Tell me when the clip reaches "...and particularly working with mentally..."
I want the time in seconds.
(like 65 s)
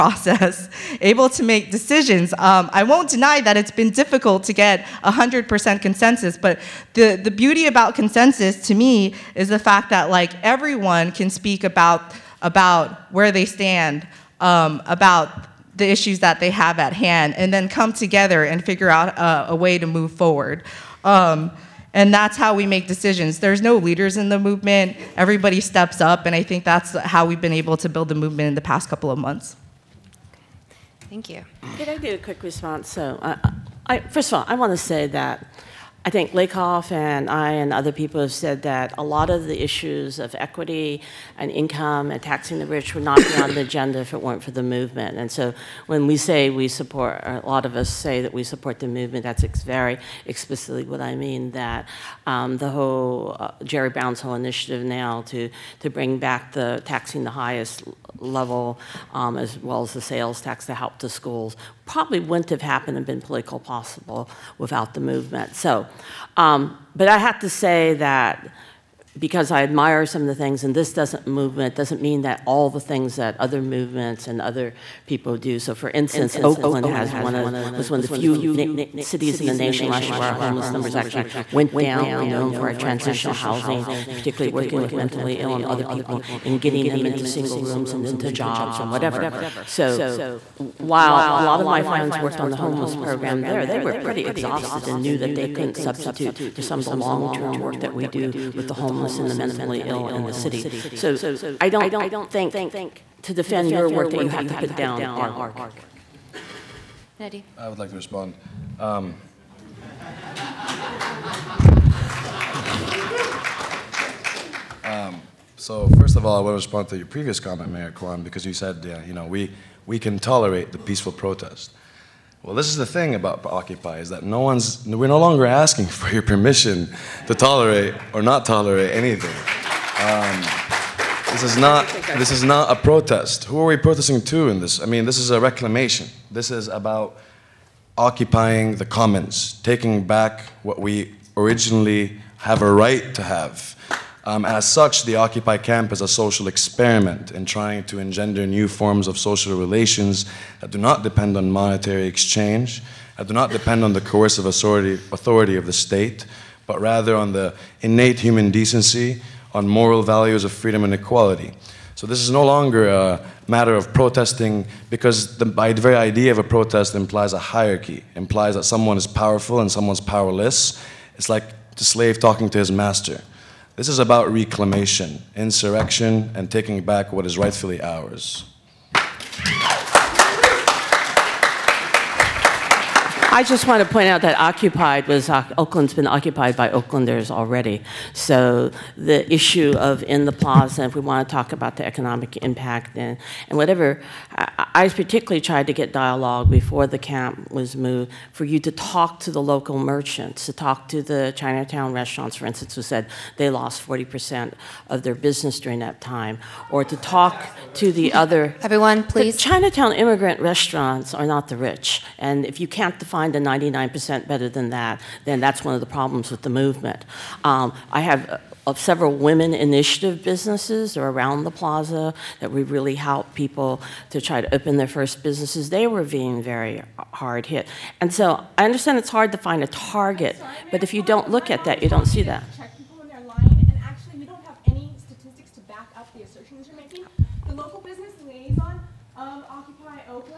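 84 s.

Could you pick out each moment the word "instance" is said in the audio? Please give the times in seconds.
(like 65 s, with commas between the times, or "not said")
75 s, 202 s.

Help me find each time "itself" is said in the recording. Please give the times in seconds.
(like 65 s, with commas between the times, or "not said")
not said.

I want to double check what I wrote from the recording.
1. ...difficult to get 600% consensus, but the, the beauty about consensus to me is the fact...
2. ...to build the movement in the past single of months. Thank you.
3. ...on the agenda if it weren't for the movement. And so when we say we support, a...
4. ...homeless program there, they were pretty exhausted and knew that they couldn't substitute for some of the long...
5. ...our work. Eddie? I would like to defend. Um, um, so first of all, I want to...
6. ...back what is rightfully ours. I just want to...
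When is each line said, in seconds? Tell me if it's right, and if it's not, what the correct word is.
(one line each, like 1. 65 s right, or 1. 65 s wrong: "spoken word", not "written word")
1. 3 s wrong: "100", not "600"
2. 27 s wrong: "couple", not "single"
3. 43 s right
4. 92 s right
5. 105 s wrong: "respond", not "defend"
6. 176 s right.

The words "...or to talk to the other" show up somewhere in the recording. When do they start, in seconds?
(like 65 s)
206 s.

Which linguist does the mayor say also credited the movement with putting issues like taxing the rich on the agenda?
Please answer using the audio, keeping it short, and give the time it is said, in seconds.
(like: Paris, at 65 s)
Lakoff, at 36 s.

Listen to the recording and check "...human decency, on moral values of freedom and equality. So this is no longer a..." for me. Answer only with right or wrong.
right.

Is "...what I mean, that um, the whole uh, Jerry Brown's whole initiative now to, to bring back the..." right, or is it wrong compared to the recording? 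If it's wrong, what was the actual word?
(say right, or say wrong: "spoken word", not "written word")
right.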